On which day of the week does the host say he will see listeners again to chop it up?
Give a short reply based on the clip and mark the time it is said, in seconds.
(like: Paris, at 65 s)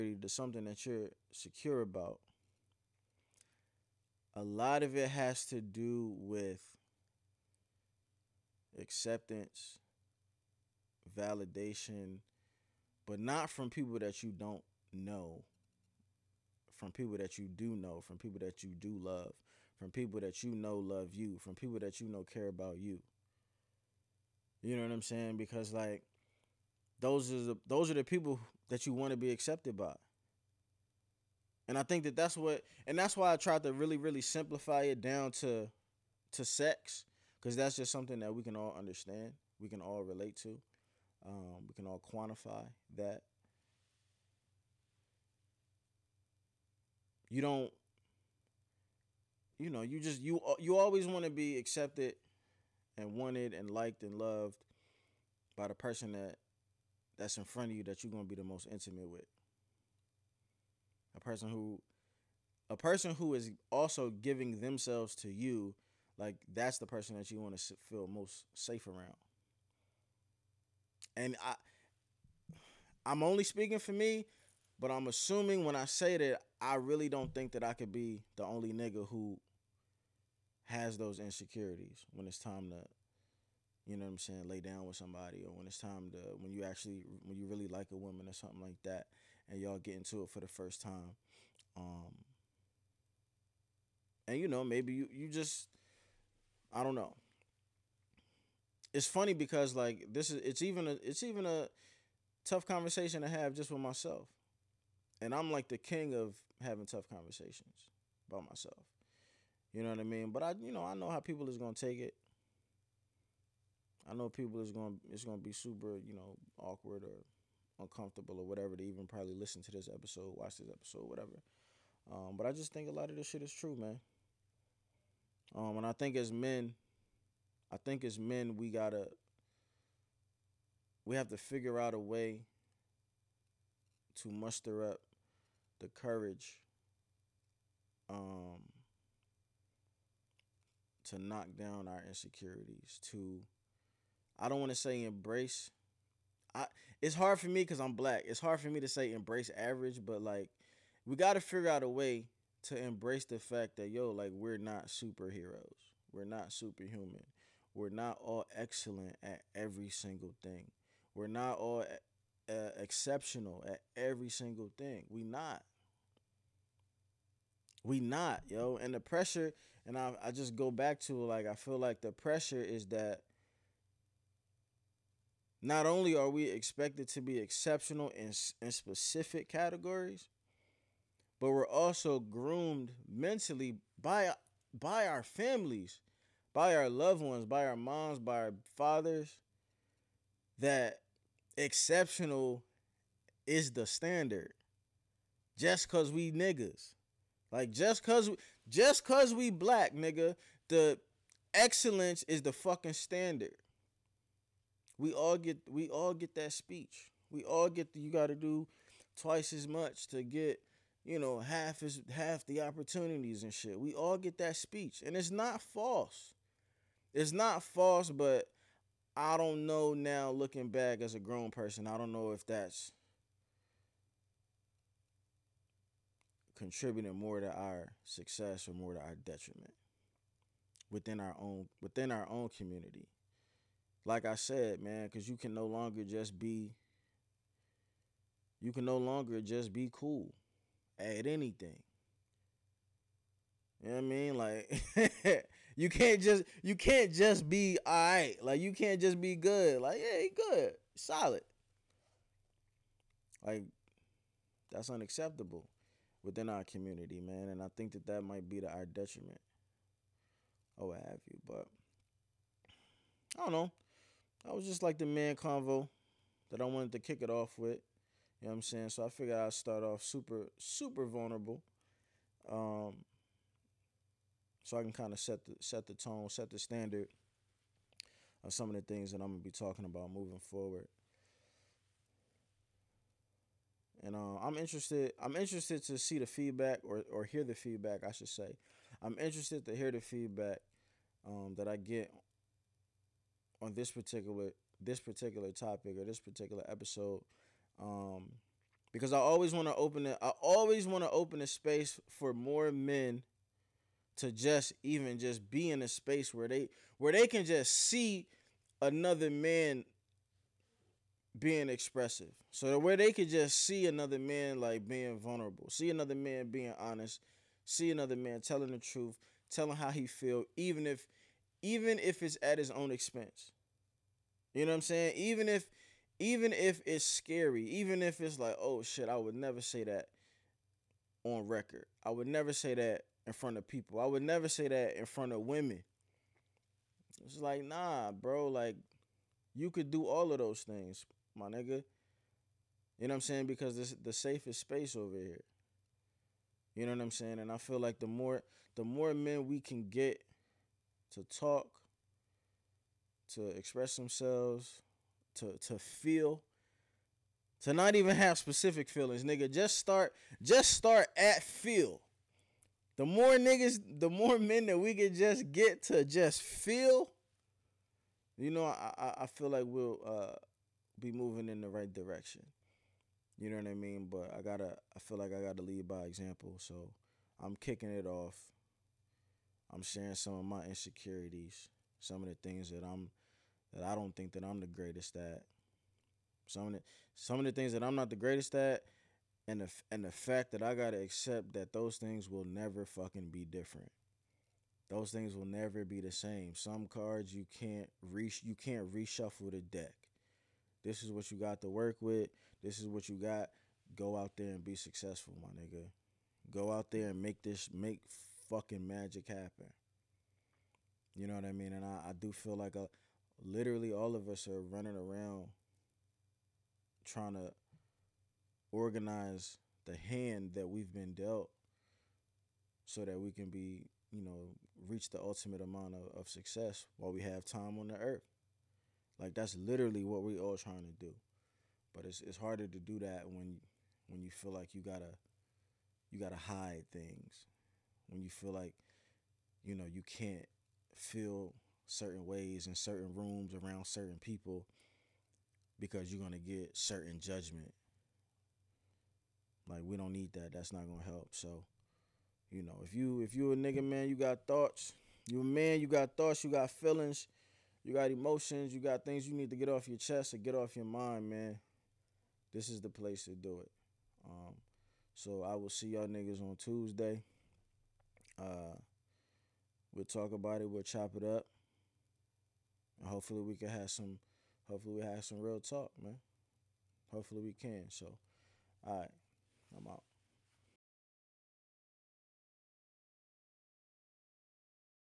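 Tuesday, at 466 s.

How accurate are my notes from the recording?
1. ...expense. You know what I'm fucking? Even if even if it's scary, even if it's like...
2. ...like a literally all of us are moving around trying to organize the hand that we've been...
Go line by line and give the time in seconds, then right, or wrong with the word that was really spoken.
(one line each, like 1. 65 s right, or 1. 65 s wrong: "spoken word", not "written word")
1. 322 s wrong: "saying", not "fucking"
2. 412 s wrong: "running", not "moving".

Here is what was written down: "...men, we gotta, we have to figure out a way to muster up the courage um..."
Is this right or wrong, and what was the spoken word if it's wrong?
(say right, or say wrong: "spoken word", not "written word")
right.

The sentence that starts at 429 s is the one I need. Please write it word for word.
Like that's literally what we are all trying to do.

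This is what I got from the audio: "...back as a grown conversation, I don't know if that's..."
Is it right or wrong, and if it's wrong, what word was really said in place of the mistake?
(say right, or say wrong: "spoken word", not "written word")
wrong: "person", not "conversation".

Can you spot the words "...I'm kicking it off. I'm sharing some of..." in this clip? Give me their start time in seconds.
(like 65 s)
377 s.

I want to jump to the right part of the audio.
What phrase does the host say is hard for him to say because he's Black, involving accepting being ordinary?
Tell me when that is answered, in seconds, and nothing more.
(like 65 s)
149 s.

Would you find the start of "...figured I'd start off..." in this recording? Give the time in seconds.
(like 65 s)
269 s.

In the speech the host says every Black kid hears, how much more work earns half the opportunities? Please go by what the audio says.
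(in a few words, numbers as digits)
Twice as much.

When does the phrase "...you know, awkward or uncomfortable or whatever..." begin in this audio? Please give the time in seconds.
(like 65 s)
115 s.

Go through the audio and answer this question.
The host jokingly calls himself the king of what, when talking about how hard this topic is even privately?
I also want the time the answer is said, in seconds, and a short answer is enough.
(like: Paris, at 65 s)
Having tough conversations by myself, at 106 s.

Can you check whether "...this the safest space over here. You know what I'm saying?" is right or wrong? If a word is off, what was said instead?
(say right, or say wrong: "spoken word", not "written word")
right.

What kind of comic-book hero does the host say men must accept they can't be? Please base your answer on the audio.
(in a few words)
Superheroes.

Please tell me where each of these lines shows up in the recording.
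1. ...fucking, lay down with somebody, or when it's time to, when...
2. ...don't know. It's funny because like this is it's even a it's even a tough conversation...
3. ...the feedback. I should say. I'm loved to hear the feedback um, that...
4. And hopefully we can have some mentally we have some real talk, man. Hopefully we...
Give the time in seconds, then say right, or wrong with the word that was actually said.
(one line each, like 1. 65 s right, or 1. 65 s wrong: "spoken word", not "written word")
1. 84 s wrong: "saying", not "fucking"
2. 96 s right
3. 287 s wrong: "interested", not "loved"
4. 472 s wrong: "hopefully", not "mentally".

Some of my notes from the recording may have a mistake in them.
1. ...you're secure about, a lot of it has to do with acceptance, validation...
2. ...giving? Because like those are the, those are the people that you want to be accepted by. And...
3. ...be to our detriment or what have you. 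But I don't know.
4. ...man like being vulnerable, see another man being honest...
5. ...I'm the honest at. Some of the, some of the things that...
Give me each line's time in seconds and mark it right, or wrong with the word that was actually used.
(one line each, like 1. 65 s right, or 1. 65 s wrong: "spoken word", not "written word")
1. 0 s right
2. 25 s wrong: "saying", not "giving"
3. 258 s right
4. 314 s right
5. 384 s wrong: "greatest", not "honest".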